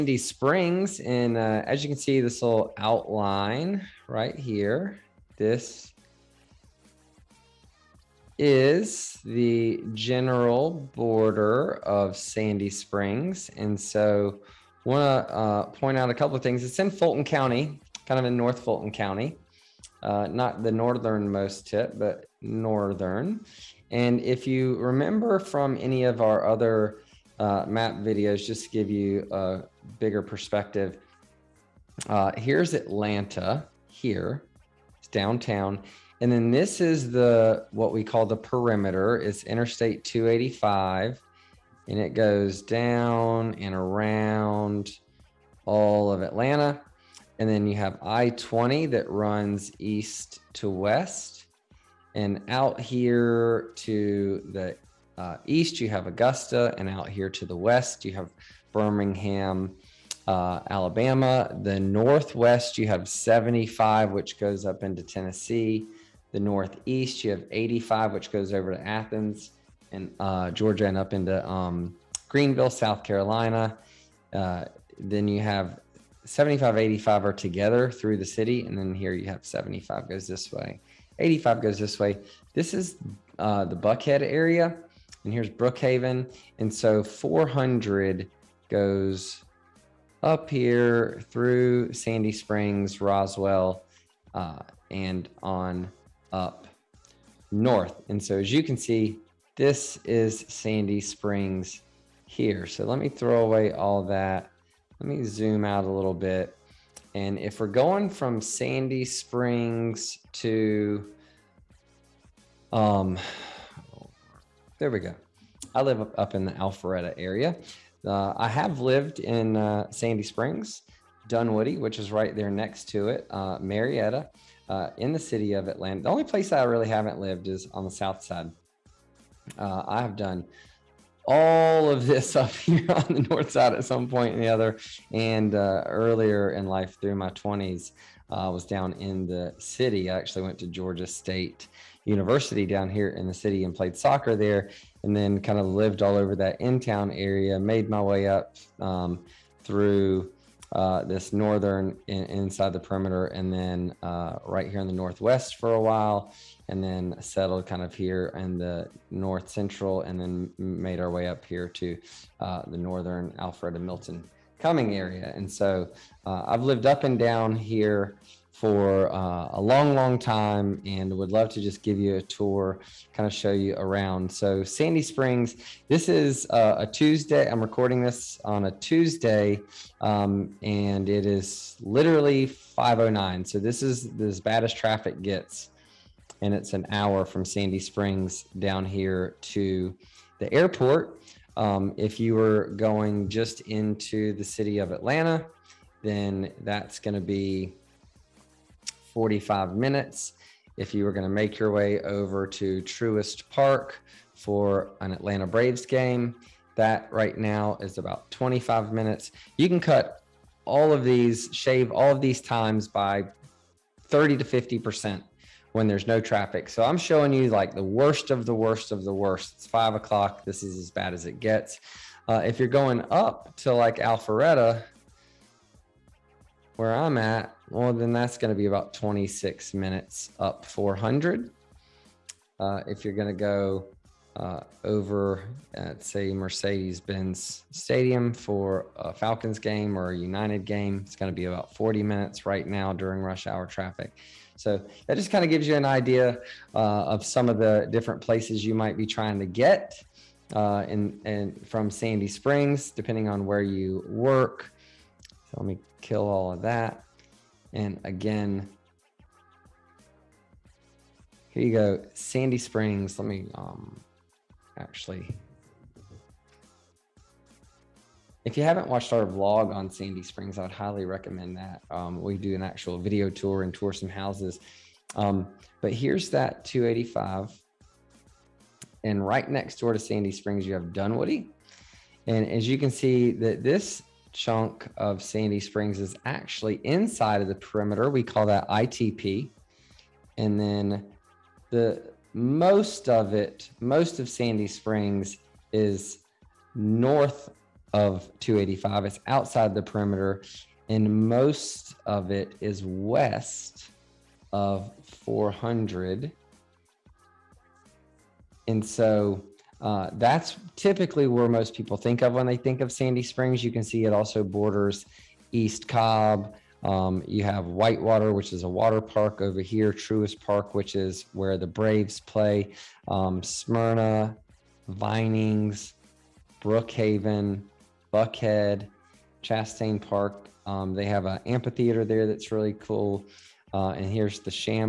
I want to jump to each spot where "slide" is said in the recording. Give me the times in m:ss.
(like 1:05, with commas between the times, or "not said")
not said.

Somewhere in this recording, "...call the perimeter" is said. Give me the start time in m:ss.
0:38.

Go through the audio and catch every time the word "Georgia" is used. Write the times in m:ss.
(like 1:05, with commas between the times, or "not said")
1:10, 2:20.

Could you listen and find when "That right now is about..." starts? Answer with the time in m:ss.
3:26.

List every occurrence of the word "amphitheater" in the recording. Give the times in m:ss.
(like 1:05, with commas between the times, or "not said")
5:31.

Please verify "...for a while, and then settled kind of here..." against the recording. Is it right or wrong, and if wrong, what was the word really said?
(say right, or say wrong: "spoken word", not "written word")
right.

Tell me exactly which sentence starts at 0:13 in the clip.
And so I want to uh, point out a couple of things.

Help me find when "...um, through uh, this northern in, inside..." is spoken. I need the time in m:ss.
2:28.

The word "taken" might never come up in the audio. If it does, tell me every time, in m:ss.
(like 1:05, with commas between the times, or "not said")
not said.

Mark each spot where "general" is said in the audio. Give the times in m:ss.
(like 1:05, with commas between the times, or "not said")
0:09.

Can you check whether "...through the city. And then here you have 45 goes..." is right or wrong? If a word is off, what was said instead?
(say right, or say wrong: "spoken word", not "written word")
wrong: "75", not "45".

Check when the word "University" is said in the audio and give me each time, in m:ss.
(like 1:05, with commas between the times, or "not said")
2:22.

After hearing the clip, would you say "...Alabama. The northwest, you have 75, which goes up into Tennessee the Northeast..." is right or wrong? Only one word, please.
right.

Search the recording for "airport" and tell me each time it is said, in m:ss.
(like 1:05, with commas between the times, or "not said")
3:10.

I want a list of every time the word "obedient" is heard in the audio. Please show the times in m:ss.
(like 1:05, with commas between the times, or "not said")
not said.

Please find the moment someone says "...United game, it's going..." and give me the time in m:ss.
4:00.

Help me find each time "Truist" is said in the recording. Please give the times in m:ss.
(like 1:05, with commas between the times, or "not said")
3:22, 5:19.